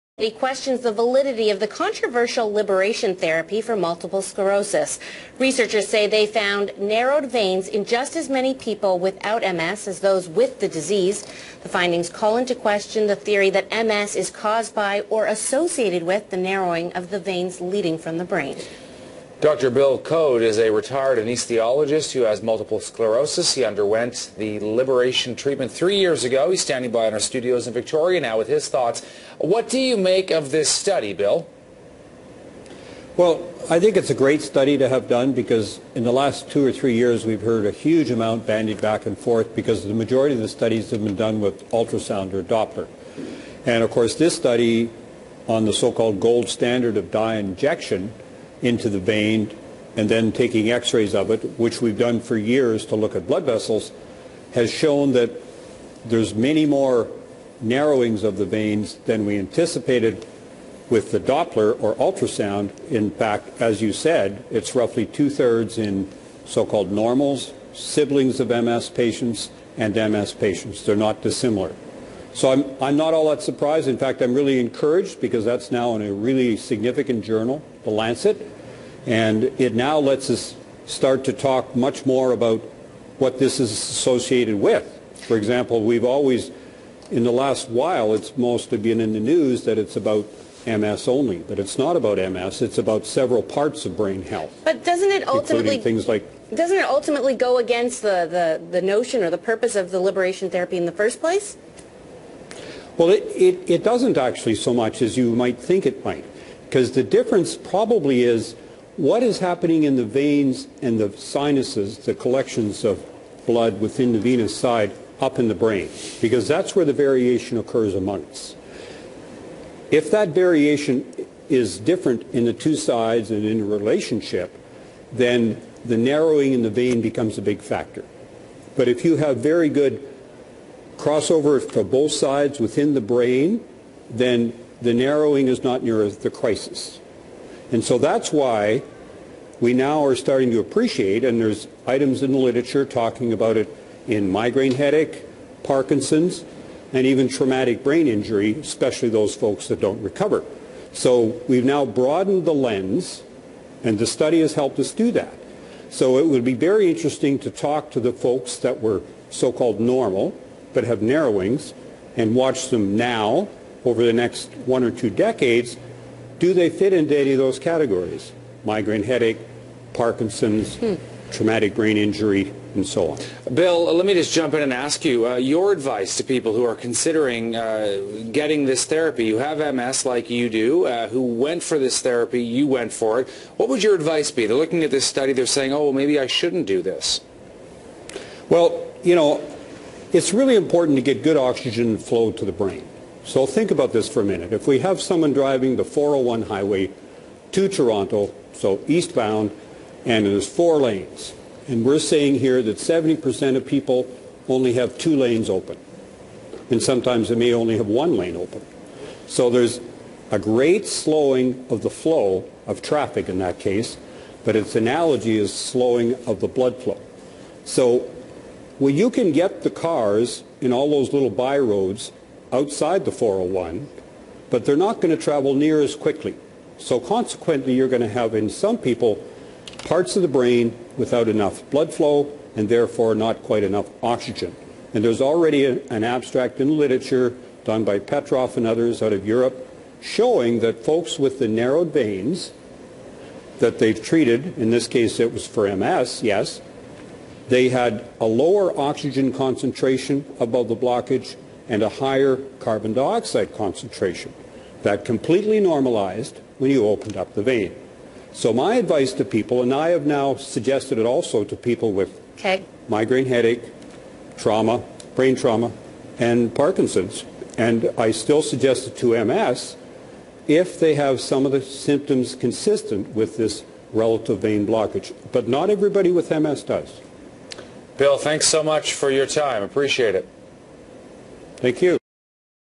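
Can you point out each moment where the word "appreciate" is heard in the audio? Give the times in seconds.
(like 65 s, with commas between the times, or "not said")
140 s, 279 s.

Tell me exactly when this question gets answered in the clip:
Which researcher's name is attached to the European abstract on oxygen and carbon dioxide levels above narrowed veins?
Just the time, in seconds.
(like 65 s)
237 s.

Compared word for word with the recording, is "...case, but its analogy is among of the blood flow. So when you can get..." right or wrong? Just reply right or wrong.
wrong.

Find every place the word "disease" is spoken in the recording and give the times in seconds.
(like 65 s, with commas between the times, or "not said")
10 s.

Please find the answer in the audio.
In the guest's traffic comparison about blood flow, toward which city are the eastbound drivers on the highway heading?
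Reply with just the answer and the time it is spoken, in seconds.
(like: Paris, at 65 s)
Toronto, at 197 s.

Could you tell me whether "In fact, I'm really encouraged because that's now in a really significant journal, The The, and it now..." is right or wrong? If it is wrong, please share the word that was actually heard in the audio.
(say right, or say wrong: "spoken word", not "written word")
wrong: "Lancet", not "The".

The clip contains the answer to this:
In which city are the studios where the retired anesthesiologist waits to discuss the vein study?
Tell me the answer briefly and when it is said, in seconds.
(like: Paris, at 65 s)
Victoria, at 27 s.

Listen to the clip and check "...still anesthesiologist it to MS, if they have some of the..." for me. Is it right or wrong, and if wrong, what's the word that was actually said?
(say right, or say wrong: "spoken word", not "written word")
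wrong: "suggest", not "anesthesiologist".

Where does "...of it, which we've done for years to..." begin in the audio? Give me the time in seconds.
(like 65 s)
51 s.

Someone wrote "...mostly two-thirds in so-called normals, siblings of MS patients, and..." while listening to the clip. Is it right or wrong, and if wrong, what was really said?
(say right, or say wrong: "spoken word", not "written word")
wrong: "roughly", not "mostly".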